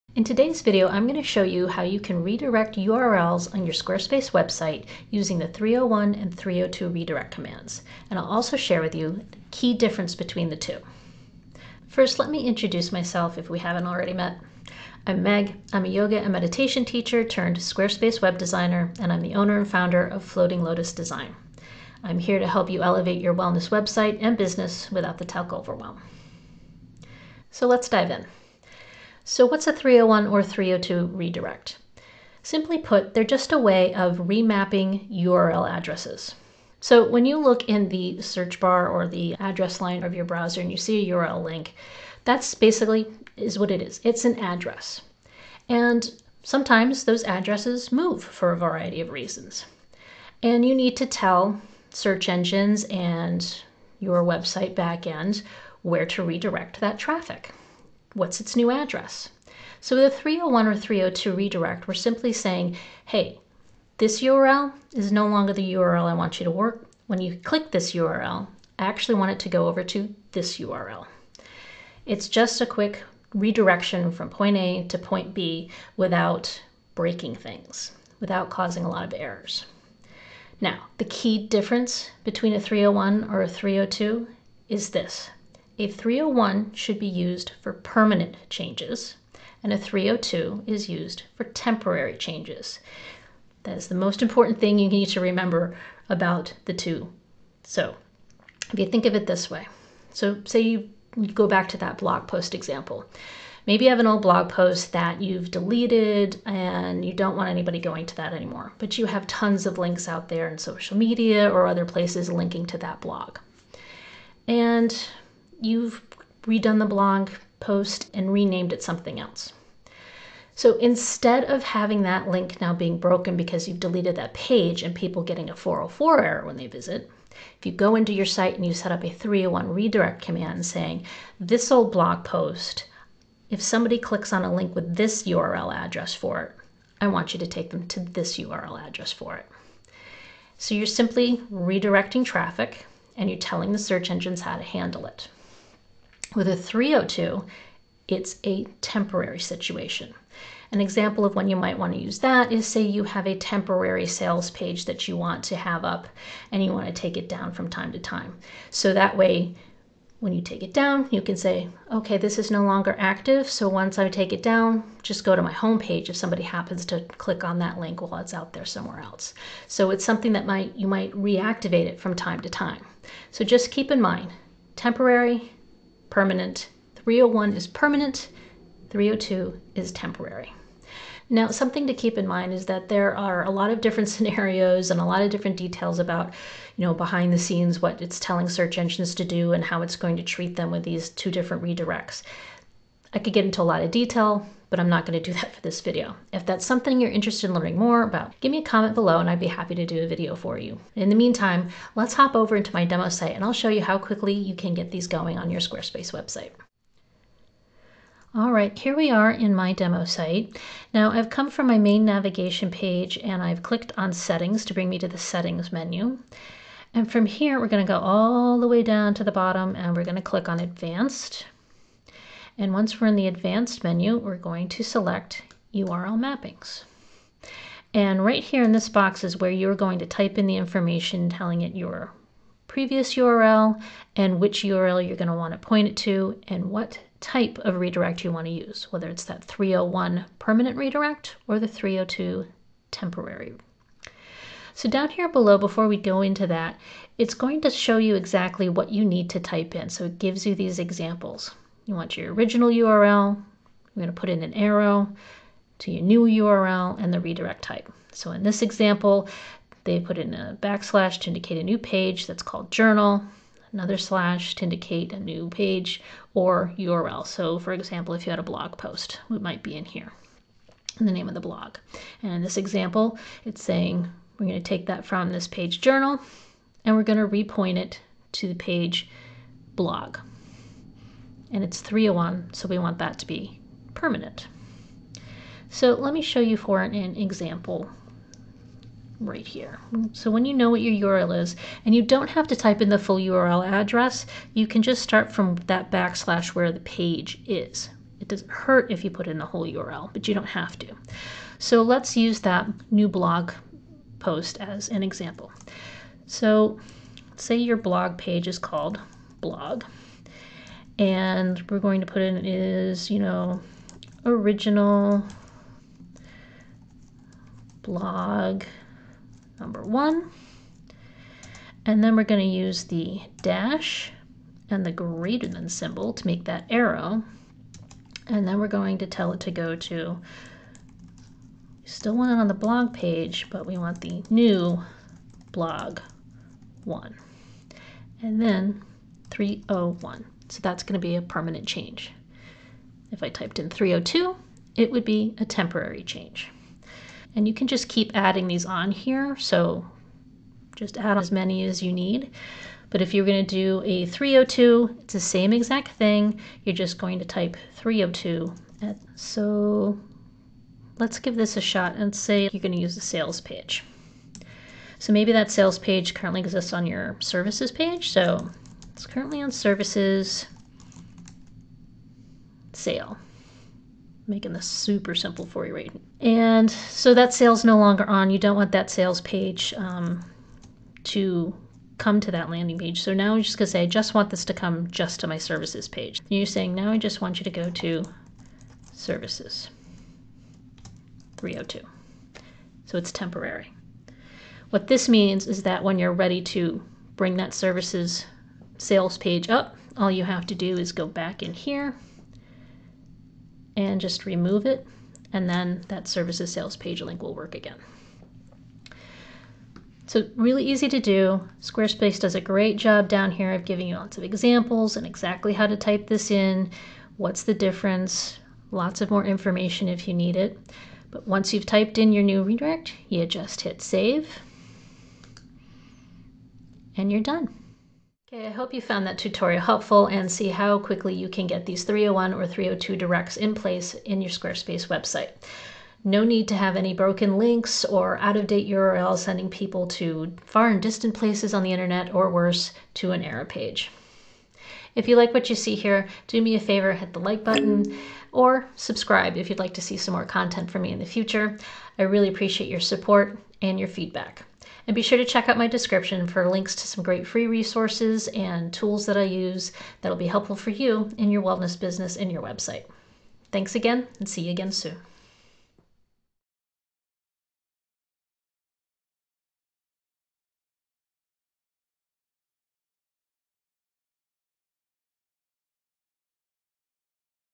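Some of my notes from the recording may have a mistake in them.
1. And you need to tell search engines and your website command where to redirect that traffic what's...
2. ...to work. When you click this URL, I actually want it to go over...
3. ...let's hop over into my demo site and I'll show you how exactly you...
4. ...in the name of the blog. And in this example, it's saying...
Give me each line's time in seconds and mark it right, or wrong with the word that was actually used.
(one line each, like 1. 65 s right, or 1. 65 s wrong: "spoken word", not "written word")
1. 50 s wrong: "backend", not "command"
2. 66 s right
3. 201 s wrong: "quickly", not "exactly"
4. 270 s right.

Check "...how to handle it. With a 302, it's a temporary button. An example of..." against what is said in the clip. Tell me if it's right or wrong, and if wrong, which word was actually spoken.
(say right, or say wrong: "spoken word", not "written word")
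wrong: "situation", not "button".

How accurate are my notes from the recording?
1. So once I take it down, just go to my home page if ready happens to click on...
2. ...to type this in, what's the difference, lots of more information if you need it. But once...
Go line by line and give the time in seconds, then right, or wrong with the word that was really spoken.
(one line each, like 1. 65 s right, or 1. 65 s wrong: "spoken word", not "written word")
1. 163 s wrong: "somebody", not "ready"
2. 415 s right.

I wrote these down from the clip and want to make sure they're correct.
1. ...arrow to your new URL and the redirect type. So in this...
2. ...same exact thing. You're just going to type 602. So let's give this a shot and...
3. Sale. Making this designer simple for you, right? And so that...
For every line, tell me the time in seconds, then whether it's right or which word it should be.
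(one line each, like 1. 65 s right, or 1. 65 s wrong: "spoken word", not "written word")
1. 254 s right
2. 355 s wrong: "302", not "602"
3. 372 s wrong: "super", not "designer".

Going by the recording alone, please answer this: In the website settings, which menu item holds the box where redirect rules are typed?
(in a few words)
URL mappings.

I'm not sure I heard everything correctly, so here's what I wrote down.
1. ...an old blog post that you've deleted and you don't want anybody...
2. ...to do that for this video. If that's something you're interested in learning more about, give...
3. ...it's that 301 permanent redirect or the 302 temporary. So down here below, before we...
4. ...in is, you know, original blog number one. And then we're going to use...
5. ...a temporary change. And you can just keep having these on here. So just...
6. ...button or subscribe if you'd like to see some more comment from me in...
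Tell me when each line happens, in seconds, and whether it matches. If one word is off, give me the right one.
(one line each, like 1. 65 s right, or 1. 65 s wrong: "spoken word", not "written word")
1. 103 s right
2. 195 s right
3. 239 s right
4. 312 s right
5. 345 s wrong: "adding", not "having"
6. 447 s wrong: "content", not "comment".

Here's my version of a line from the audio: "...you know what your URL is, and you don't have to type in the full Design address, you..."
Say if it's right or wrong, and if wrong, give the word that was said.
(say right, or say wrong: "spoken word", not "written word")
wrong: "URL", not "Design".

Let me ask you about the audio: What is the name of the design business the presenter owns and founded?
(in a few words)
Floating Lotus Design.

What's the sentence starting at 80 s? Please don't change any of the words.
Now, the key difference between a 301 or a 302 is this.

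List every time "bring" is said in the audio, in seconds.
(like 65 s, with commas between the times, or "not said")
214 s, 397 s.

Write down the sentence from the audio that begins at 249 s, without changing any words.
So it gives you these examples.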